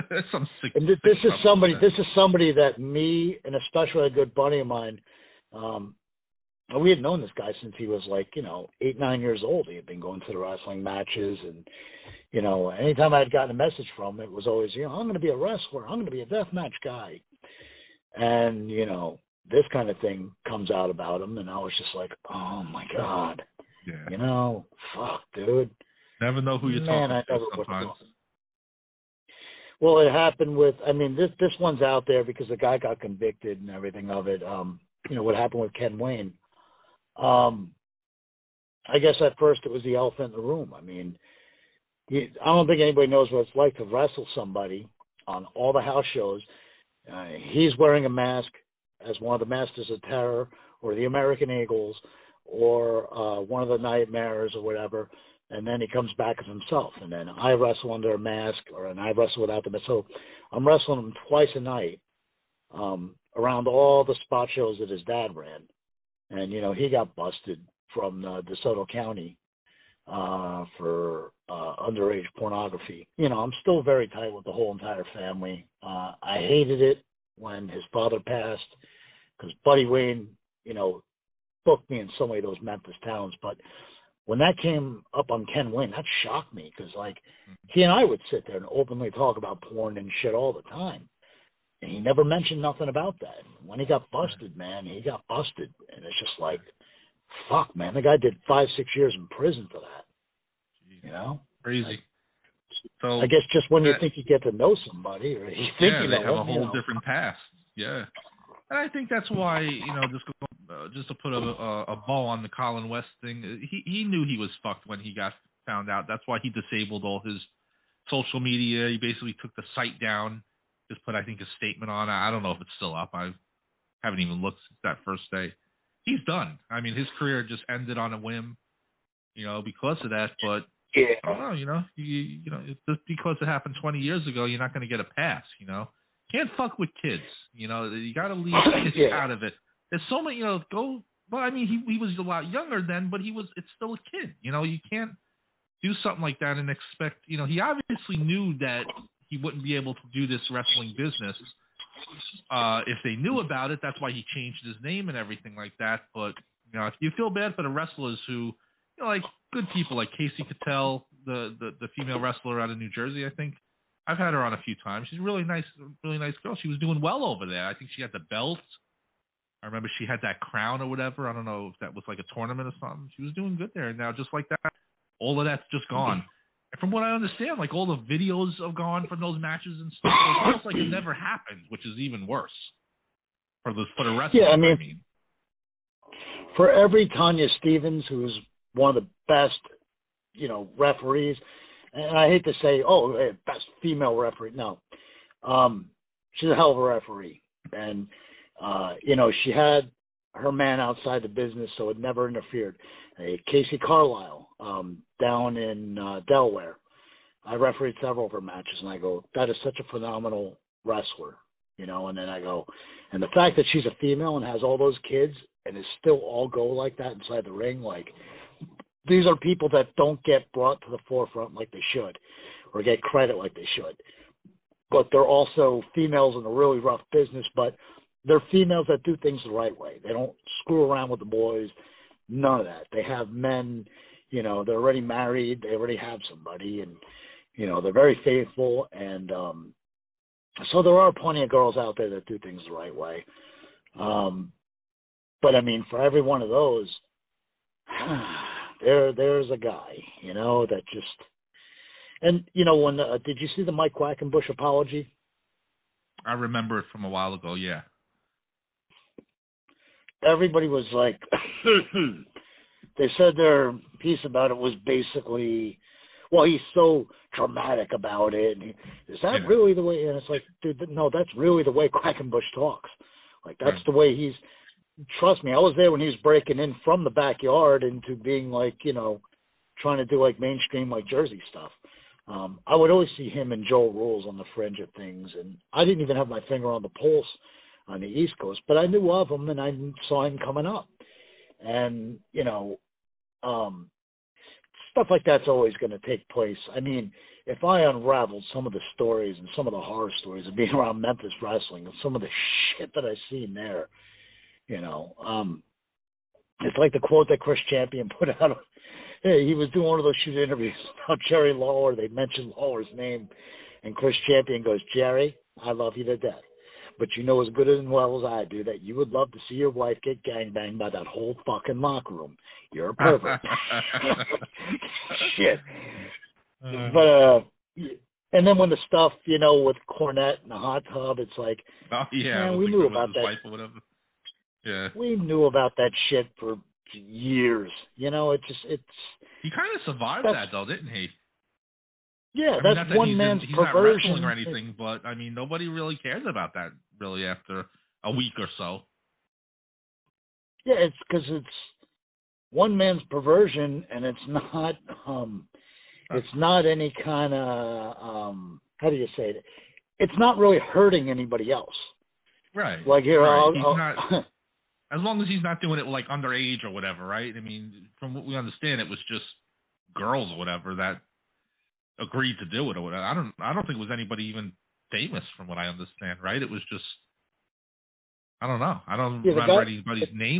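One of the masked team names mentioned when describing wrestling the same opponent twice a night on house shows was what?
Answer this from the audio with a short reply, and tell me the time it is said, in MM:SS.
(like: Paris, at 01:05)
Masters of Terror, at 00:49.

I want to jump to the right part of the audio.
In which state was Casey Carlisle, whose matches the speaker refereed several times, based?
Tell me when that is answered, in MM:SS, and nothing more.
03:26.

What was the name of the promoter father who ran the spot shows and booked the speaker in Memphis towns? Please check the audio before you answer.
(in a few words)
Buddy Wayne.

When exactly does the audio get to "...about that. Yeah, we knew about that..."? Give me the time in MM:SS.
05:32.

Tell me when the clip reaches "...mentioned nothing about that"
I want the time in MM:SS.
01:32.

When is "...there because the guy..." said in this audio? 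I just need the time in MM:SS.
00:32.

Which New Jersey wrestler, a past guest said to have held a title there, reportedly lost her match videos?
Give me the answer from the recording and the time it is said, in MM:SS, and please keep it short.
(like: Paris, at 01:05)
Casey Cattell, at 02:40.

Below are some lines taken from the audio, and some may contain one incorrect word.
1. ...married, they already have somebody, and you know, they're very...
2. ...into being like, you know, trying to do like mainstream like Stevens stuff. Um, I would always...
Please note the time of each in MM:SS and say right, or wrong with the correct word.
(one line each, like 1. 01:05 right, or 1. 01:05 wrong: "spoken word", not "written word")
1. 03:54 right
2. 04:37 wrong: "Jersey", not "Stevens".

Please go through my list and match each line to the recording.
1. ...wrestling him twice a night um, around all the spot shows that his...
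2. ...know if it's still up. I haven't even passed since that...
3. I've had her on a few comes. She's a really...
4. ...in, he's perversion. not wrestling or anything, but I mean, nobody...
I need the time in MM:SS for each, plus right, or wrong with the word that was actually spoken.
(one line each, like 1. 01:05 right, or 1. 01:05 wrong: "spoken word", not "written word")
1. 01:00 right
2. 02:02 wrong: "looked", not "passed"
3. 02:44 wrong: "times", not "comes"
4. 05:43 right.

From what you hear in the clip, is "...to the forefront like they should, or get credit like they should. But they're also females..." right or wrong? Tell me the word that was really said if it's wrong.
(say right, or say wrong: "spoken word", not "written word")
right.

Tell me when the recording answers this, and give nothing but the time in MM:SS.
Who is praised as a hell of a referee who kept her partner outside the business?
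03:07.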